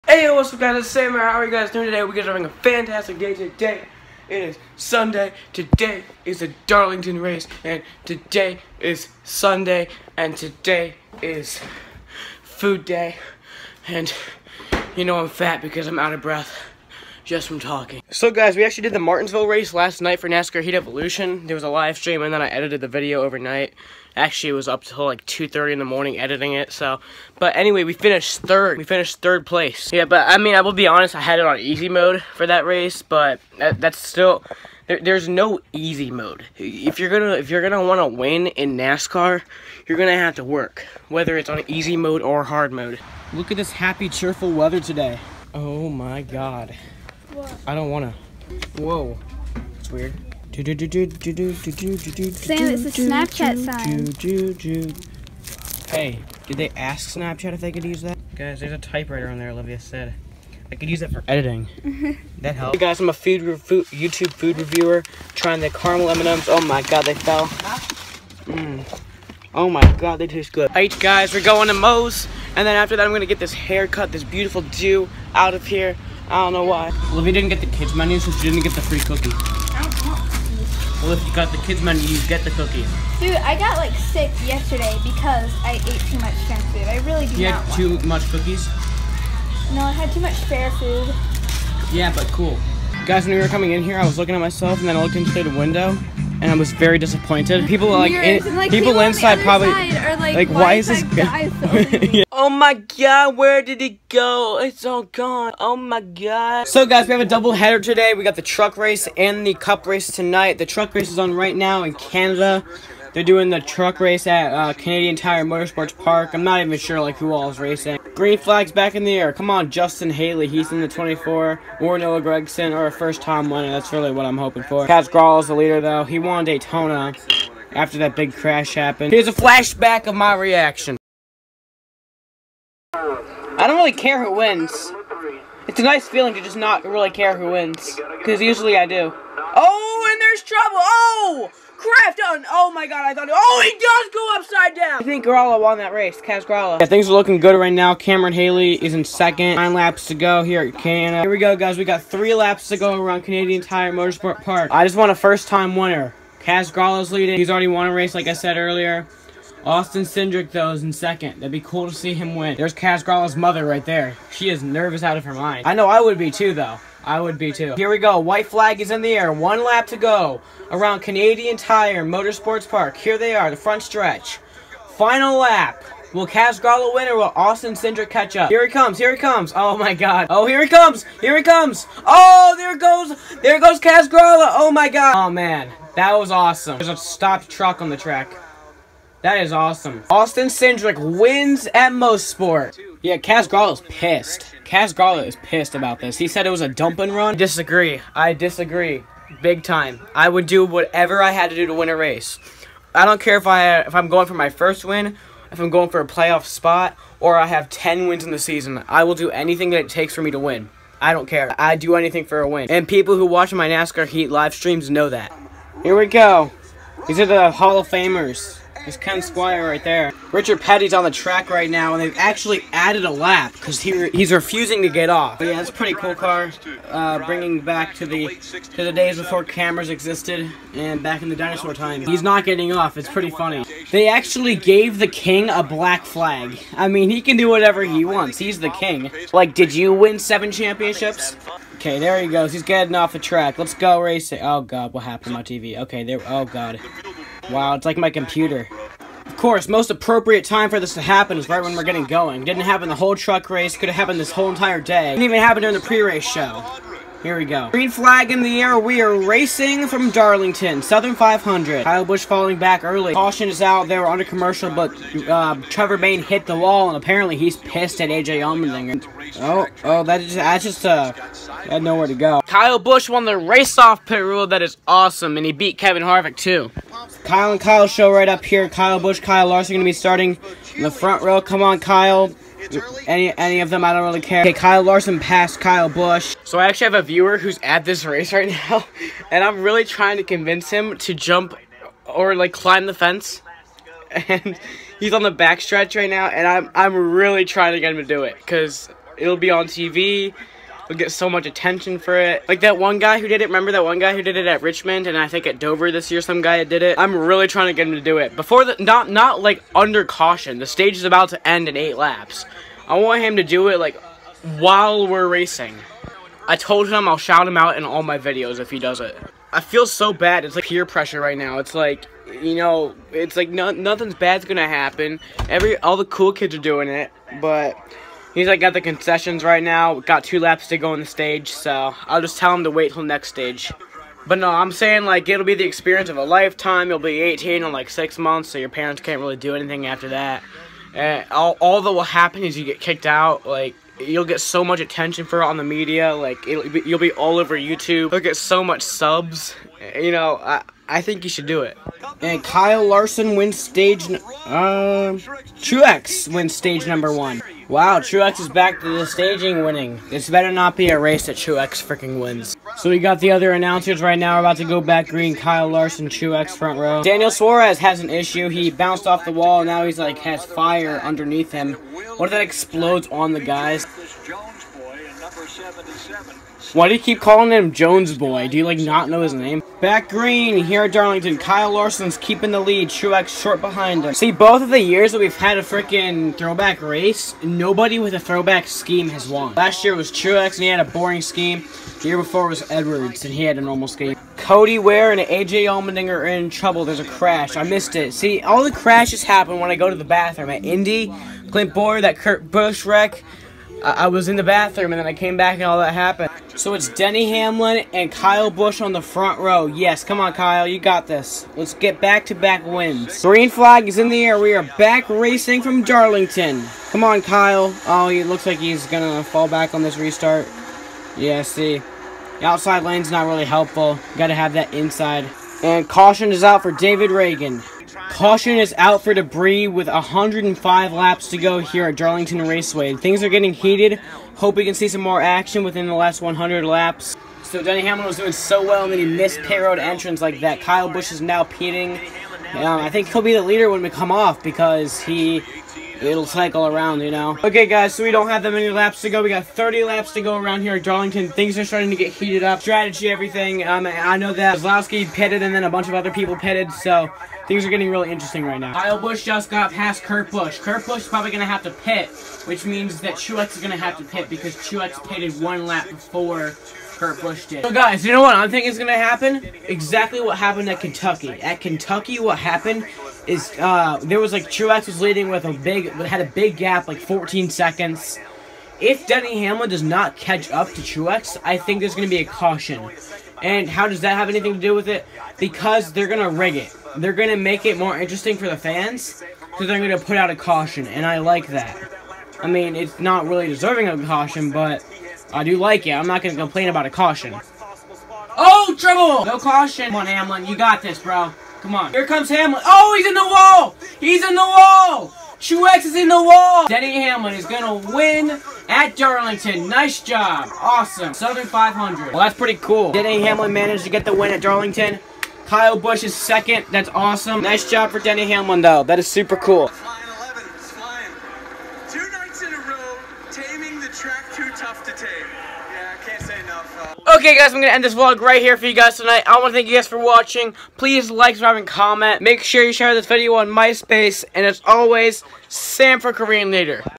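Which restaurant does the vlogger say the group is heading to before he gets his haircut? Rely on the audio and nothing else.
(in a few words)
Moe's.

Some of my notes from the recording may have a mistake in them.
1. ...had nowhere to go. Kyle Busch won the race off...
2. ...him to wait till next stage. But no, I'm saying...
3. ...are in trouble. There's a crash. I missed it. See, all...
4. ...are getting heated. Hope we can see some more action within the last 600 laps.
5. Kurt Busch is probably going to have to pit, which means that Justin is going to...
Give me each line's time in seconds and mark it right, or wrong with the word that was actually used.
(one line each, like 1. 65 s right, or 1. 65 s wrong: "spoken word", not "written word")
1. 271 s right
2. 332 s right
3. 396 s right
4. 433 s wrong: "100", not "600"
5. 460 s wrong: "Truex", not "Justin".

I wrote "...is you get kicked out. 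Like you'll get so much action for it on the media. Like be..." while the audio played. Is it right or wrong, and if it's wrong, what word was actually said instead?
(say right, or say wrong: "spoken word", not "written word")
wrong: "attention", not "action".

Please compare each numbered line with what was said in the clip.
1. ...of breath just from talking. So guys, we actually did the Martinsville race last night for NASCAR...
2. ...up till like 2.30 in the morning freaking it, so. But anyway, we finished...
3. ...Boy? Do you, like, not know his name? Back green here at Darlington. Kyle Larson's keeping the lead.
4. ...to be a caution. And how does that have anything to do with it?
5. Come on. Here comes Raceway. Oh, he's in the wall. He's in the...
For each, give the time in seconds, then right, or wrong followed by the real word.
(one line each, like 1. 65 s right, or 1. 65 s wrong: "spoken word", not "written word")
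1. 16 s right
2. 24 s wrong: "editing", not "freaking"
3. 378 s right
4. 482 s right
5. 501 s wrong: "Hamlin", not "Raceway".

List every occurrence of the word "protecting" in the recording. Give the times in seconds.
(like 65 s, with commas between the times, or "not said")
not said.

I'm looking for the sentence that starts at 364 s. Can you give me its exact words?
We're about to go back green.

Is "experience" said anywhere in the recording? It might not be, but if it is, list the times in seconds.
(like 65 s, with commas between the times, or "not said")
335 s.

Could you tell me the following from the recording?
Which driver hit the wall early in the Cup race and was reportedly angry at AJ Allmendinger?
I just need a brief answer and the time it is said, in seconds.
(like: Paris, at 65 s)
Trevor Bayne, at 265 s.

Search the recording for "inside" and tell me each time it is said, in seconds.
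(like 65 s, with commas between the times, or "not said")
99 s, 424 s.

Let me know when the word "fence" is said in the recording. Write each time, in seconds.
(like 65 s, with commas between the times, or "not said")
292 s.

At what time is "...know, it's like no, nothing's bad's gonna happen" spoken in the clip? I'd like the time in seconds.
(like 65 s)
322 s.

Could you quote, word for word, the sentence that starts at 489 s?
So they're going to put out a caution, and I like that.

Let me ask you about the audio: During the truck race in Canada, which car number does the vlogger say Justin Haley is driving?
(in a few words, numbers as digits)
24.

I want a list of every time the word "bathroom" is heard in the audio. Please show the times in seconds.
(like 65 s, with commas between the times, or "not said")
400 s, 404 s.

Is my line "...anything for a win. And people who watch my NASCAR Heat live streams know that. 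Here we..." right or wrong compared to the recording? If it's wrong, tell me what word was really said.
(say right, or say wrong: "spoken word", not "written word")
right.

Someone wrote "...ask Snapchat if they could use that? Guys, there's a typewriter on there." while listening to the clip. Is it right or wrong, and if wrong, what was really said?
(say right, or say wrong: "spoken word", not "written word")
right.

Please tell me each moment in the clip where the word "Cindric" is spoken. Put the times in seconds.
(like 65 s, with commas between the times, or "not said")
160 s, 177 s, 190 s.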